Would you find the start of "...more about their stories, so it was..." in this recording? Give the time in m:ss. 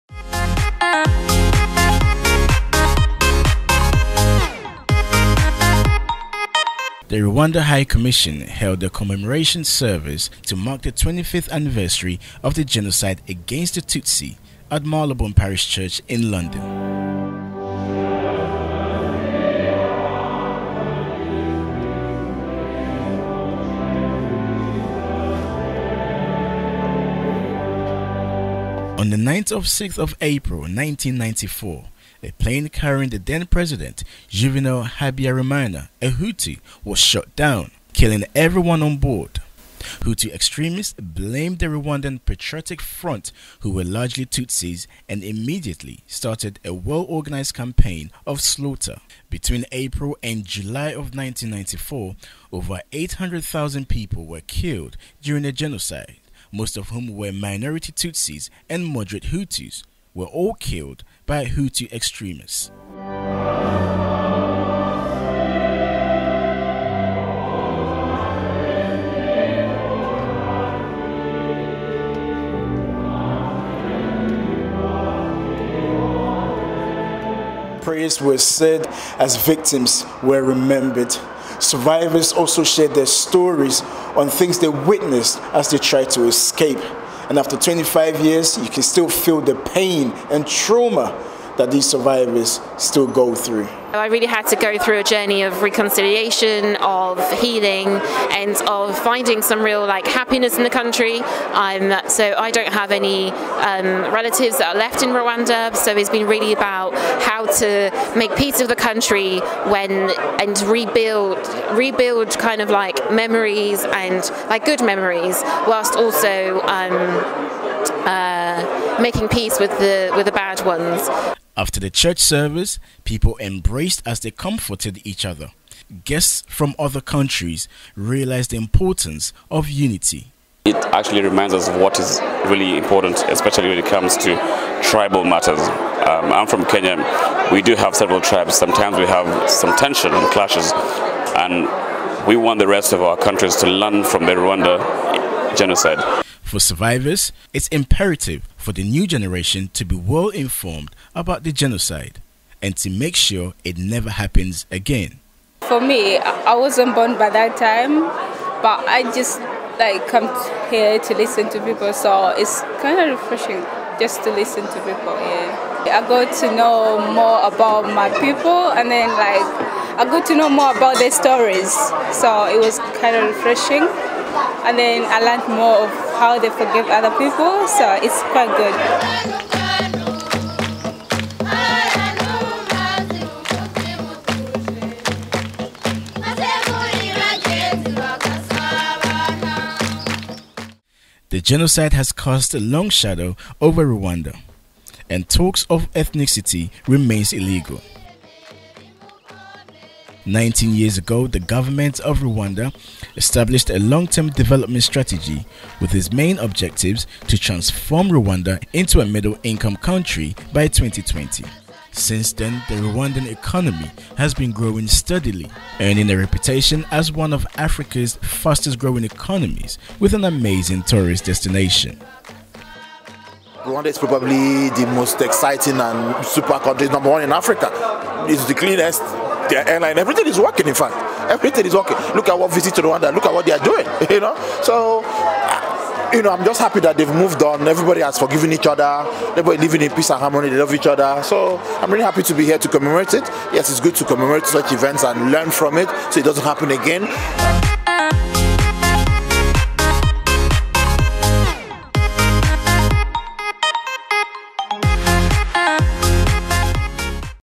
2:50.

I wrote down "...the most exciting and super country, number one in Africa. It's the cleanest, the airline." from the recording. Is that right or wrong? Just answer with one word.
right.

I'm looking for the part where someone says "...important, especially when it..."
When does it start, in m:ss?
2:12.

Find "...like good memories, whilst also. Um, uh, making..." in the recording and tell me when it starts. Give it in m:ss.
1:54.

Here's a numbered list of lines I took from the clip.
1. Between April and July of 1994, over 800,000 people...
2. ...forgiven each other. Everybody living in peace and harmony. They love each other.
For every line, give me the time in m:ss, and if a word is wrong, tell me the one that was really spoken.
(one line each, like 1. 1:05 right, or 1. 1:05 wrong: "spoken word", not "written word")
1. 0:49 right
2. 3:58 right.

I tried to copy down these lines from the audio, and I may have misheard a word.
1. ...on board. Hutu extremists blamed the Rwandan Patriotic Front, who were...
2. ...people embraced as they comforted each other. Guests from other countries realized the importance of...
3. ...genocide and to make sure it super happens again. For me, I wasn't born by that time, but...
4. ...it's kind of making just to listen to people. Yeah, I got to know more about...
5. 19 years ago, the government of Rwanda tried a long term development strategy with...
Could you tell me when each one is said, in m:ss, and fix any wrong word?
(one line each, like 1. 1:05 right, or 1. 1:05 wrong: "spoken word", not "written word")
1. 0:38 right
2. 2:03 right
3. 2:31 wrong: "never", not "super"
4. 2:42 wrong: "refreshing", not "making"
5. 3:20 wrong: "established", not "tried".